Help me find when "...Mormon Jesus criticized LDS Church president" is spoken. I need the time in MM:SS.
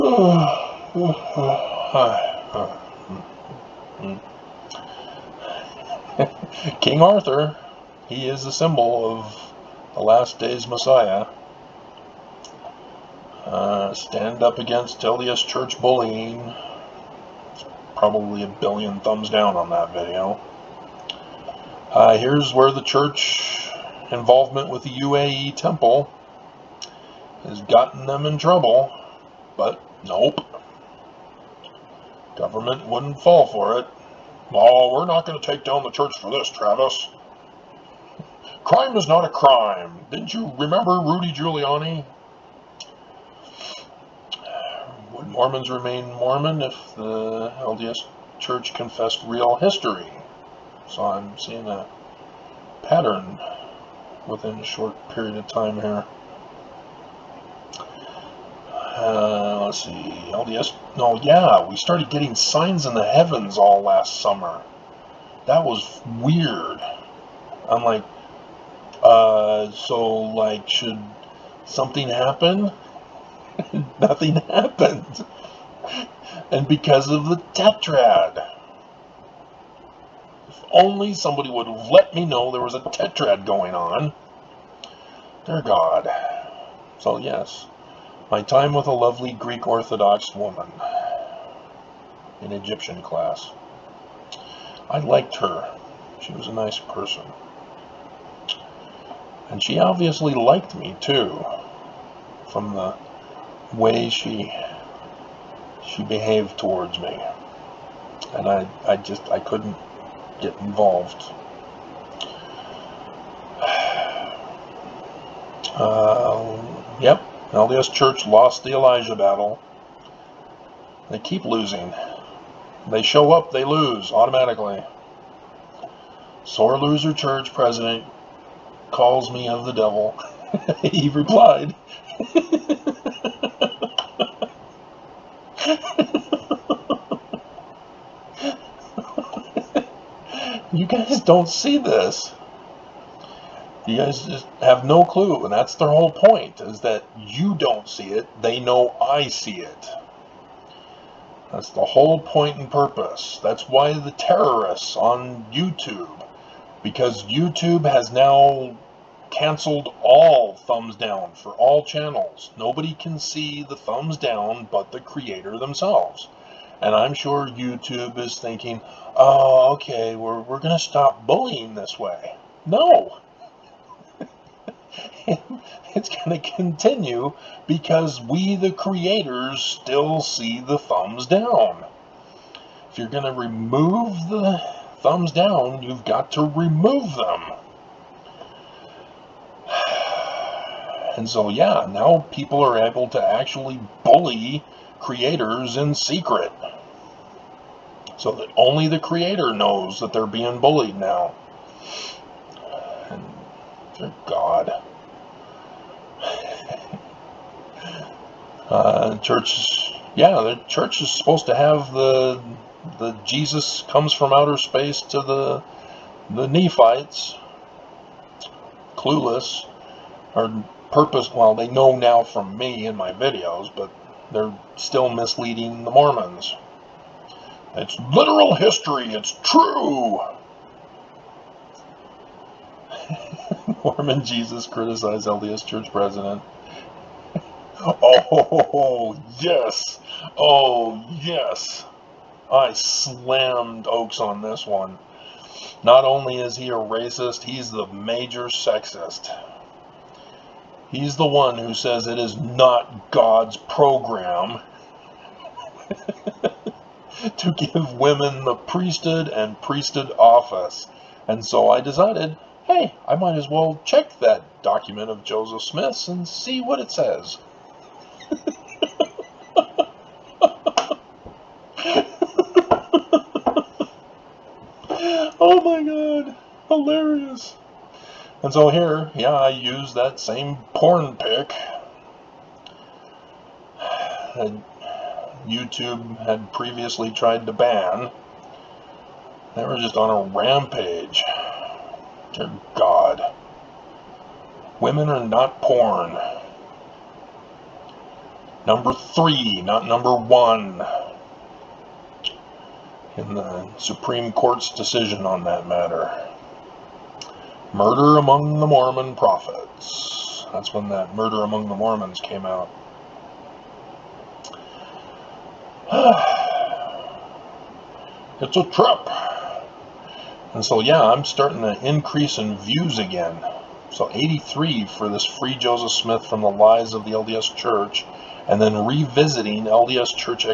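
03:53.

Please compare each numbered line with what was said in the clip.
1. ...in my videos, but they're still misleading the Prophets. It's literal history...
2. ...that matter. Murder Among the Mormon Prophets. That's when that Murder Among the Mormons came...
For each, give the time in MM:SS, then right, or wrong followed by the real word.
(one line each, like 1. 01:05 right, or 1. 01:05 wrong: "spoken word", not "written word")
1. 03:42 wrong: "Mormons", not "Prophets"
2. 05:05 right.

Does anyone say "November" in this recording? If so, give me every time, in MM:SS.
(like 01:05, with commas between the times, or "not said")
not said.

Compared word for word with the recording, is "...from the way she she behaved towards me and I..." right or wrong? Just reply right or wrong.
right.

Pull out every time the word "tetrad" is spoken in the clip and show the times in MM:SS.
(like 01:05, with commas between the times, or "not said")
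01:17, 01:22.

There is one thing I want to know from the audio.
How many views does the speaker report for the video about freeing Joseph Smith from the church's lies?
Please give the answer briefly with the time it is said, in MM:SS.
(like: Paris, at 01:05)
83, at 05:24.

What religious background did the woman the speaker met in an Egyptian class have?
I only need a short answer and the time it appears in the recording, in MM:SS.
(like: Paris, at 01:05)
Greek Orthodox, at 01:29.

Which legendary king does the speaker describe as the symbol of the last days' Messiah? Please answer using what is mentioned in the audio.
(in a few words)
King Arthur.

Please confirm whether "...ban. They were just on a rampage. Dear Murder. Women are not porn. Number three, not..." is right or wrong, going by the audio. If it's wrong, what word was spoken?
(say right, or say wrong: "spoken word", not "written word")
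wrong: "God", not "Murder".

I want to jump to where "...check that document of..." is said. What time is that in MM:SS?
04:23.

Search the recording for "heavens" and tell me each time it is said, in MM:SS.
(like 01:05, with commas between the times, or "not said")
01:03.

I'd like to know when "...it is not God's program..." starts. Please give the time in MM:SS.
04:12.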